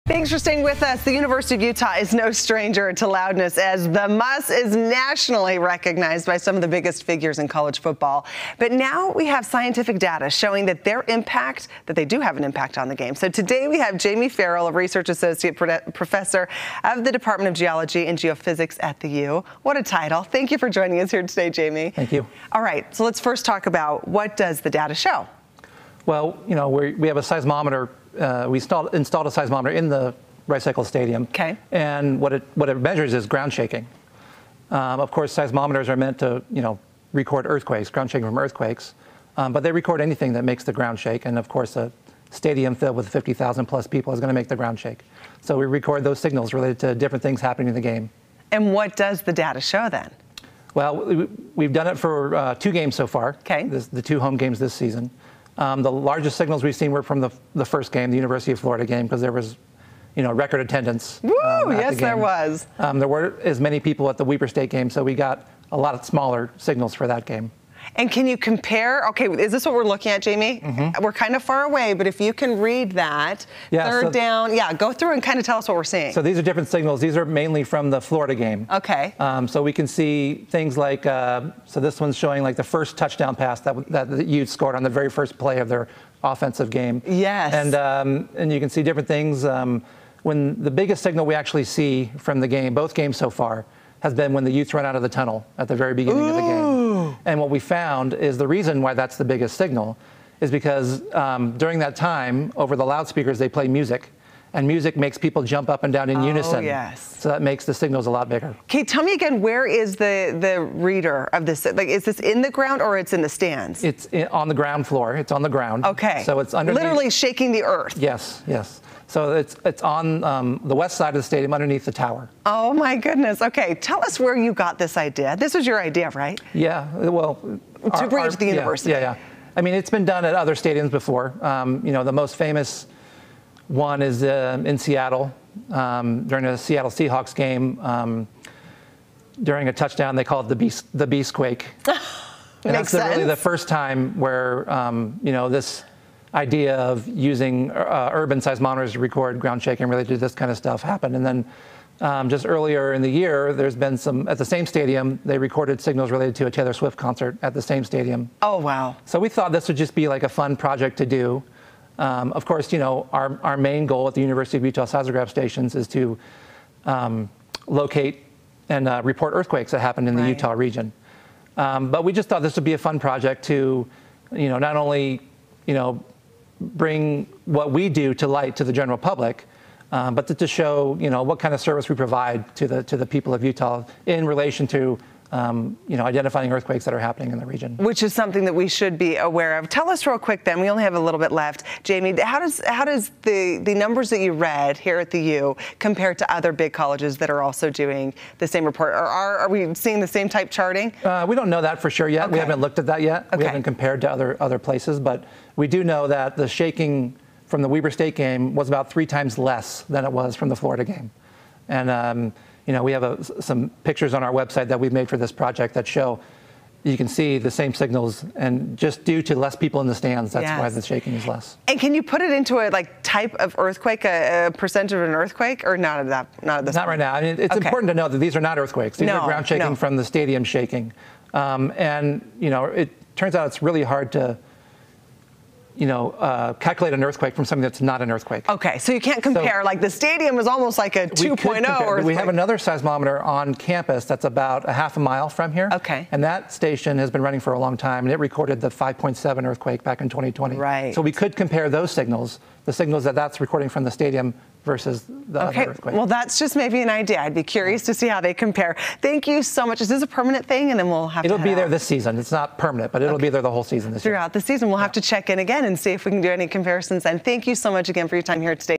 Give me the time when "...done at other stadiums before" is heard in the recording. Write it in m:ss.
2:10.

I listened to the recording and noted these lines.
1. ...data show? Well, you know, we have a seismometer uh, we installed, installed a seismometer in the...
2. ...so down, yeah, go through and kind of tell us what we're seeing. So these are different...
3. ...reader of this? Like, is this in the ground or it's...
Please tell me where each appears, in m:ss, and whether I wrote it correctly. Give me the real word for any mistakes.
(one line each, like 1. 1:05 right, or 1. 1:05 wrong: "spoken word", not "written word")
1. 0:24 right
2. 1:14 right
3. 1:50 right.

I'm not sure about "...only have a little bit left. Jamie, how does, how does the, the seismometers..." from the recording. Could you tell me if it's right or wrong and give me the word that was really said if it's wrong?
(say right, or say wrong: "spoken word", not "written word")
wrong: "numbers", not "seismometers".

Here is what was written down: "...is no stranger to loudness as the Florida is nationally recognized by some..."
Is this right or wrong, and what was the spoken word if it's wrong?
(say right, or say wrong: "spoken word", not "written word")
wrong: "MUSS", not "Florida".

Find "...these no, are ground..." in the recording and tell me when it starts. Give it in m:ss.
3:48.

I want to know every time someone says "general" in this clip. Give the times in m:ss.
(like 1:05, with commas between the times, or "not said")
2:58.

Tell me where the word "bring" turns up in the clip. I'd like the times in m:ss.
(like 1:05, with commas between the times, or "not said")
2:08, 2:56.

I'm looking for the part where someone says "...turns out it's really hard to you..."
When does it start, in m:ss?
3:53.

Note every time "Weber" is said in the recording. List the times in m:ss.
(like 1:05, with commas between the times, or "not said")
1:04, 3:27.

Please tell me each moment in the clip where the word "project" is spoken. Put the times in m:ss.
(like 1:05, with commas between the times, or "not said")
2:40, 2:52, 3:35.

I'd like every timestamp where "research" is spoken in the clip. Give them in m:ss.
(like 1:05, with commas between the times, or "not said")
0:14.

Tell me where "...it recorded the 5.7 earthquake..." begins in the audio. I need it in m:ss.
4:08.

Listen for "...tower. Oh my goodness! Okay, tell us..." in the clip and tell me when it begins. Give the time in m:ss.
2:01.